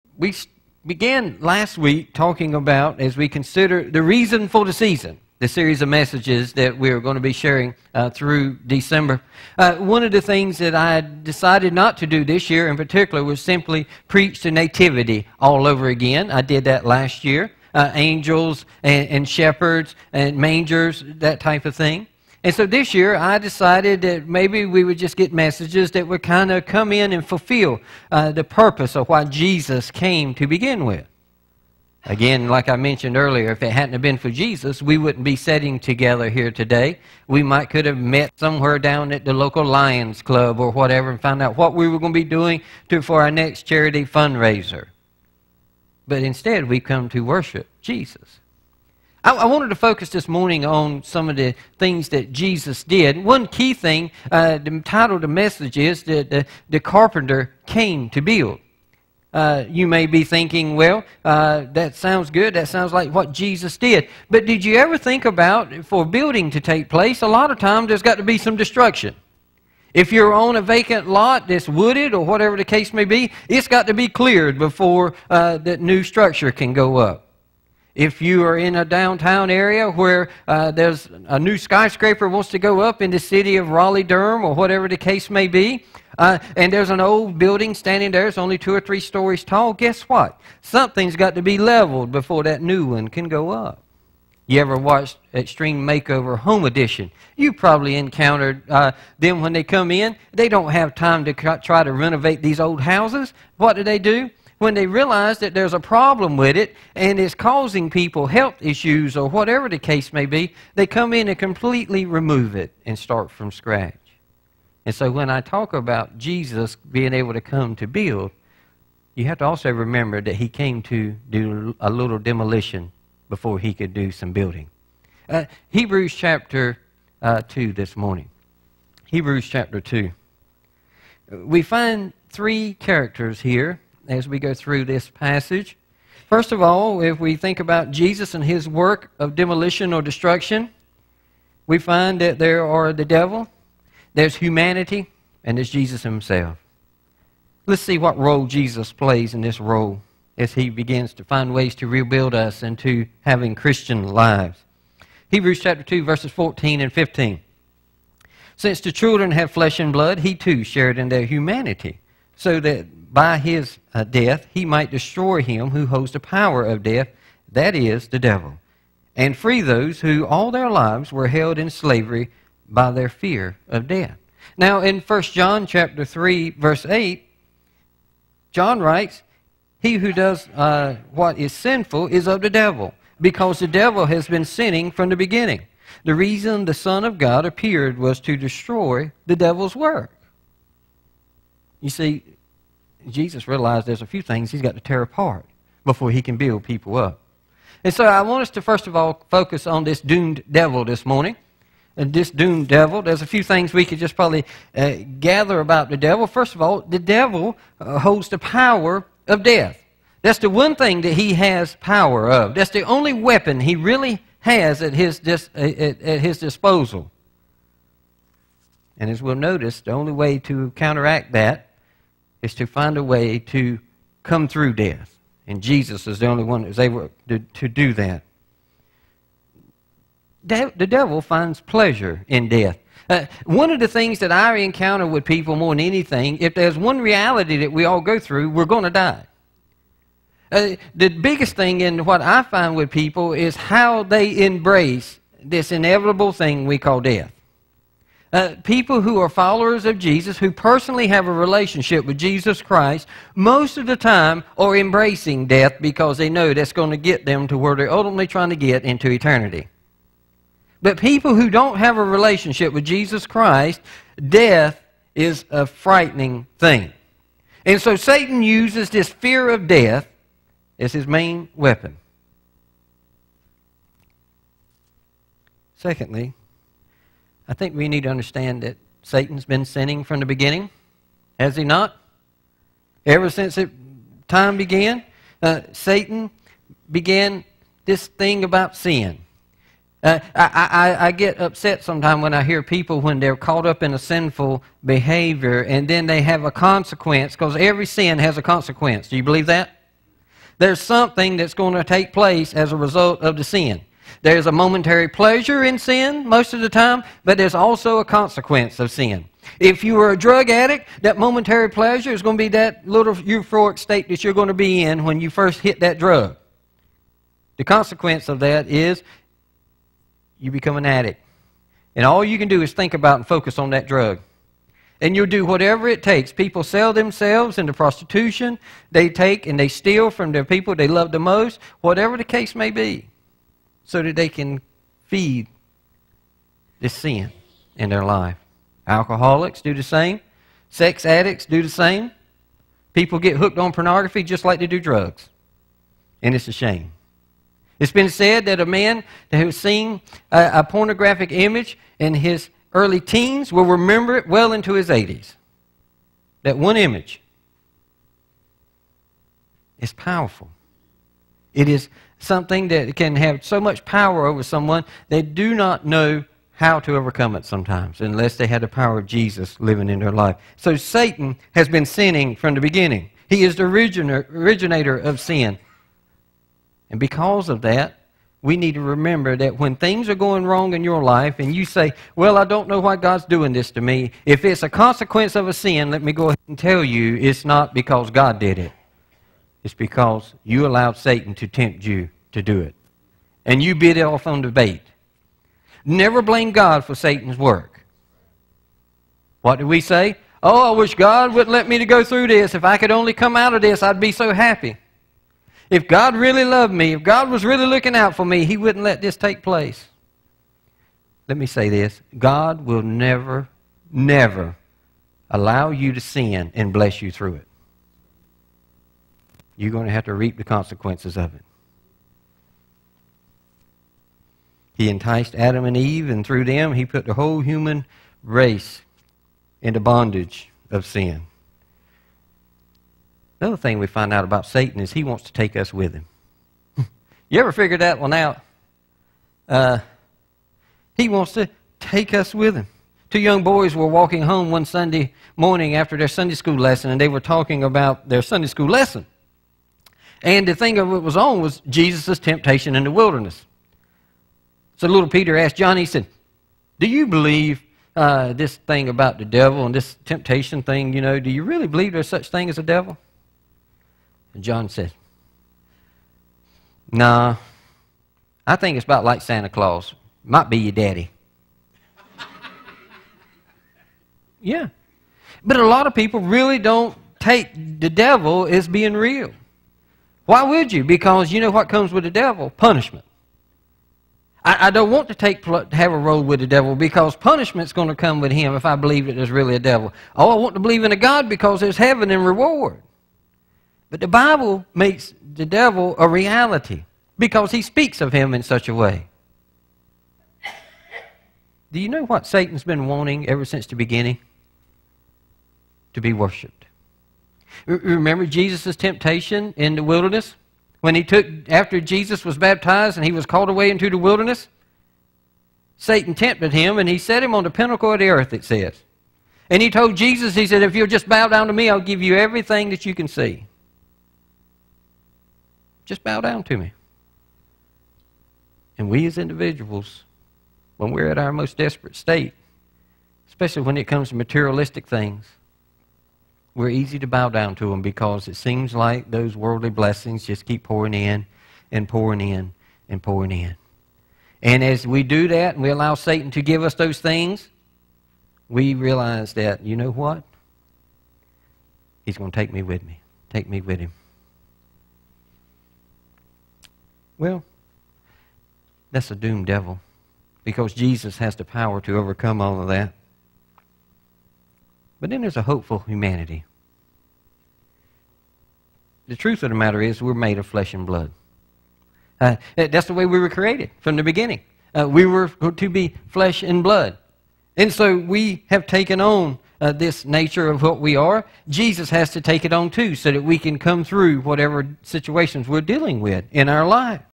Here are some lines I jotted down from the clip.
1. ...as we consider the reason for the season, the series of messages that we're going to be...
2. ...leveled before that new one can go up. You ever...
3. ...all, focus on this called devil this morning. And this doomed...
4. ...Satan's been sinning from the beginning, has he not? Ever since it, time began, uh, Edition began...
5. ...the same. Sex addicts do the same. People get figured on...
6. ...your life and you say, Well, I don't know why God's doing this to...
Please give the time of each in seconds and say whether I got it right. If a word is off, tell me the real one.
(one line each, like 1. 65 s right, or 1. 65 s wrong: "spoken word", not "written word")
1. 3 s right
2. 91 s right
3. 198 s wrong: "doomed", not "called"
4. 279 s wrong: "Satan", not "Edition"
5. 339 s wrong: "hooked", not "figured"
6. 380 s right.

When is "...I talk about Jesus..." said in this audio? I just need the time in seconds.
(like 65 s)
115 s.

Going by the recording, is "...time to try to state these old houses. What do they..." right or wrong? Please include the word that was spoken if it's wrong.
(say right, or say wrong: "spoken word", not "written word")
wrong: "renovate", not "state".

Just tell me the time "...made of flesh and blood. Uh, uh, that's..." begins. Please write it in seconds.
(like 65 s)
570 s.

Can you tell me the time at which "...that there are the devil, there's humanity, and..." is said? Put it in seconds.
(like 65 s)
142 s.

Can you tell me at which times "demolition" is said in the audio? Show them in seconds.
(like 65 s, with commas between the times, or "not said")
122 s, 139 s.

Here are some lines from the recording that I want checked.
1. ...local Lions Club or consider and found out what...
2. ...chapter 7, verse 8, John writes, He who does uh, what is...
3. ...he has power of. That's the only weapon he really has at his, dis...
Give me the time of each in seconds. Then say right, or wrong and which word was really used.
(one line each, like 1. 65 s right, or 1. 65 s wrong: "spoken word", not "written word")
1. 39 s wrong: "whatever", not "consider"
2. 175 s wrong: "3", not "7"
3. 211 s right.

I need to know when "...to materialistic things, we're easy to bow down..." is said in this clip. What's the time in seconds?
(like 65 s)
534 s.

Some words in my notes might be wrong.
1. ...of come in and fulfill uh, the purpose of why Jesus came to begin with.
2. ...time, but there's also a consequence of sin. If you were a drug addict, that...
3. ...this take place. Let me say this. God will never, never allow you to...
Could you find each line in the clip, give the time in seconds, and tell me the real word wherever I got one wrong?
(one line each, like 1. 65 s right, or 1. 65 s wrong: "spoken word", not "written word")
1. 26 s right
2. 306 s right
3. 409 s right.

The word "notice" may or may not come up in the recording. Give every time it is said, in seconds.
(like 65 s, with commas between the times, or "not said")
219 s.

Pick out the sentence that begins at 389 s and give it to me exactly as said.
It's because you allowed Satan to tempt you to do it.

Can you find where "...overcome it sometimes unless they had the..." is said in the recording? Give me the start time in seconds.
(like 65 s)
366 s.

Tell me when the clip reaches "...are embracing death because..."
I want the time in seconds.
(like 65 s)
254 s.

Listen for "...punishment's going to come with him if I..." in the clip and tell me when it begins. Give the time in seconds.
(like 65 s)
487 s.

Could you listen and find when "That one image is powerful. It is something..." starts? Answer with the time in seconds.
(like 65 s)
356 s.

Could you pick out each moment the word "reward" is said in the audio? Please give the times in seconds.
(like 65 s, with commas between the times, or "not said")
492 s.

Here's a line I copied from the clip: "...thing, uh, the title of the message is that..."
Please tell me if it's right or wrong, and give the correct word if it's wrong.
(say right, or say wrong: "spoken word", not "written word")
right.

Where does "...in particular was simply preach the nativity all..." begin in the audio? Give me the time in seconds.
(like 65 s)
12 s.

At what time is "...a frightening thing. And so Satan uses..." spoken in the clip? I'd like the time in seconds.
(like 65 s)
265 s.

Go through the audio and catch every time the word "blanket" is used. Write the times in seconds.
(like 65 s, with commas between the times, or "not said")
not said.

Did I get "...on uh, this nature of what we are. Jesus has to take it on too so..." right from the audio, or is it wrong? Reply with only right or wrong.
right.